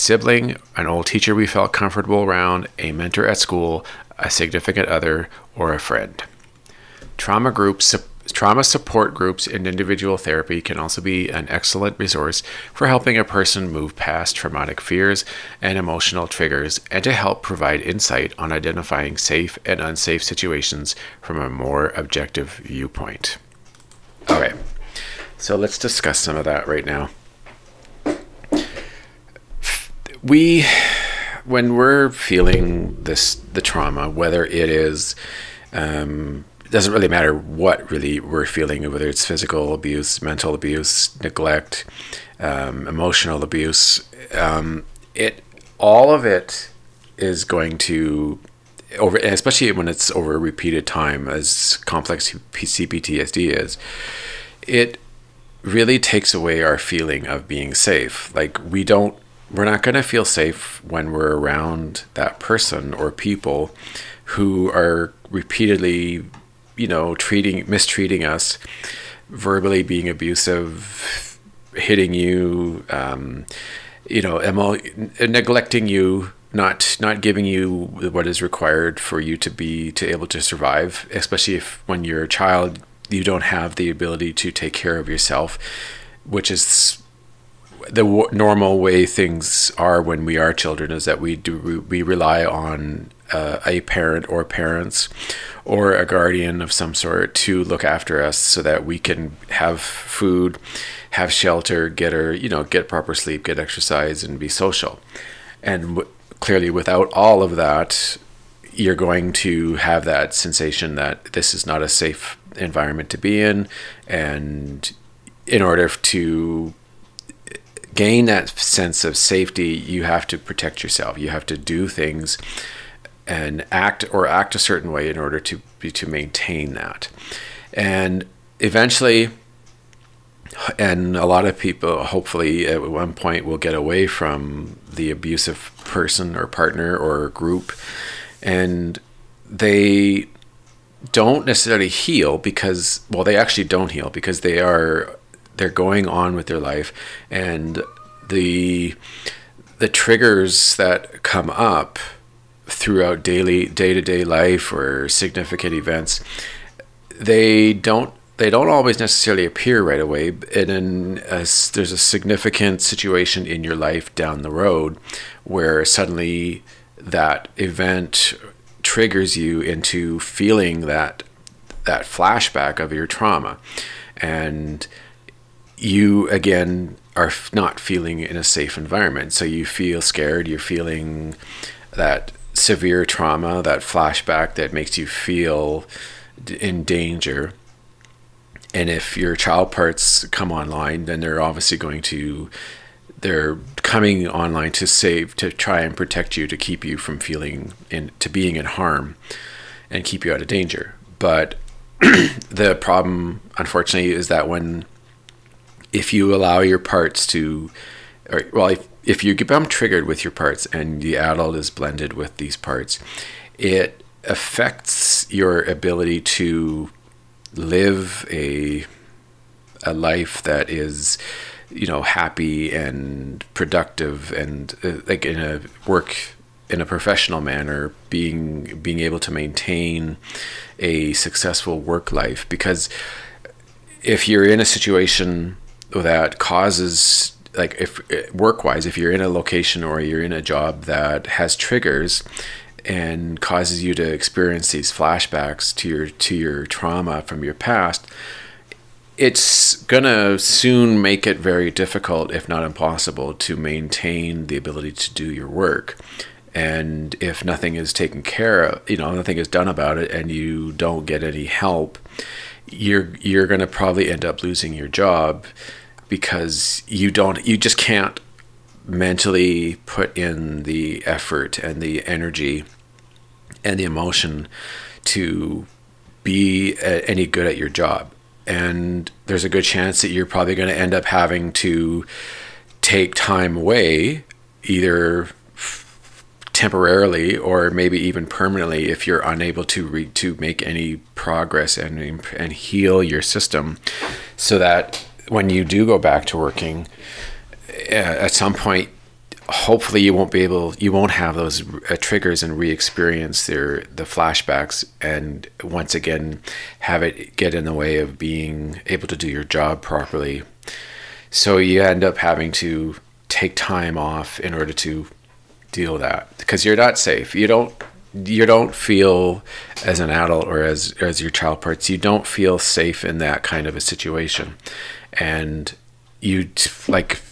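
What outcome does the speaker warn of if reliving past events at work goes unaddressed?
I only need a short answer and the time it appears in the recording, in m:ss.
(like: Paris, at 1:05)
losing your job, at 4:24.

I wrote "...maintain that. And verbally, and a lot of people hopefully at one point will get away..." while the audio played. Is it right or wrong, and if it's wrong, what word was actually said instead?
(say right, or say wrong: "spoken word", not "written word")
wrong: "eventually", not "verbally".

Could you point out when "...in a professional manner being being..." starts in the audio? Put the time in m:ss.
3:46.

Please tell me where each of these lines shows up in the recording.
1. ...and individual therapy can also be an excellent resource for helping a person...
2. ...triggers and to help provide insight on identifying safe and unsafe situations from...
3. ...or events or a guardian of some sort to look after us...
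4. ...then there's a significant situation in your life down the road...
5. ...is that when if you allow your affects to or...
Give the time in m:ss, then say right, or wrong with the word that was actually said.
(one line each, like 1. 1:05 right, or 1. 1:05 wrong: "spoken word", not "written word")
1. 0:09 right
2. 0:16 right
3. 1:34 wrong: "parents", not "events"
4. 2:40 right
5. 3:24 wrong: "parts", not "affects".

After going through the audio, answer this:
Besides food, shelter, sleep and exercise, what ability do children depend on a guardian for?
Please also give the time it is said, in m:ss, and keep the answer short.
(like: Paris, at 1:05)
be social, at 1:44.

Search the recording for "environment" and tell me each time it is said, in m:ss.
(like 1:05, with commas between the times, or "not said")
1:52, 2:58.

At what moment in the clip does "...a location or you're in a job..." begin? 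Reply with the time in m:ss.
3:59.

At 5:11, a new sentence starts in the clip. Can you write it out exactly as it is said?
So you end up having to take time off in order to deal with that because you're not safe.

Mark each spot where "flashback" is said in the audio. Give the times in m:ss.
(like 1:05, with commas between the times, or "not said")
2:52, 3:03, 4:04, 5:04.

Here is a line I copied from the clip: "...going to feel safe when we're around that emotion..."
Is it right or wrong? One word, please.
wrong.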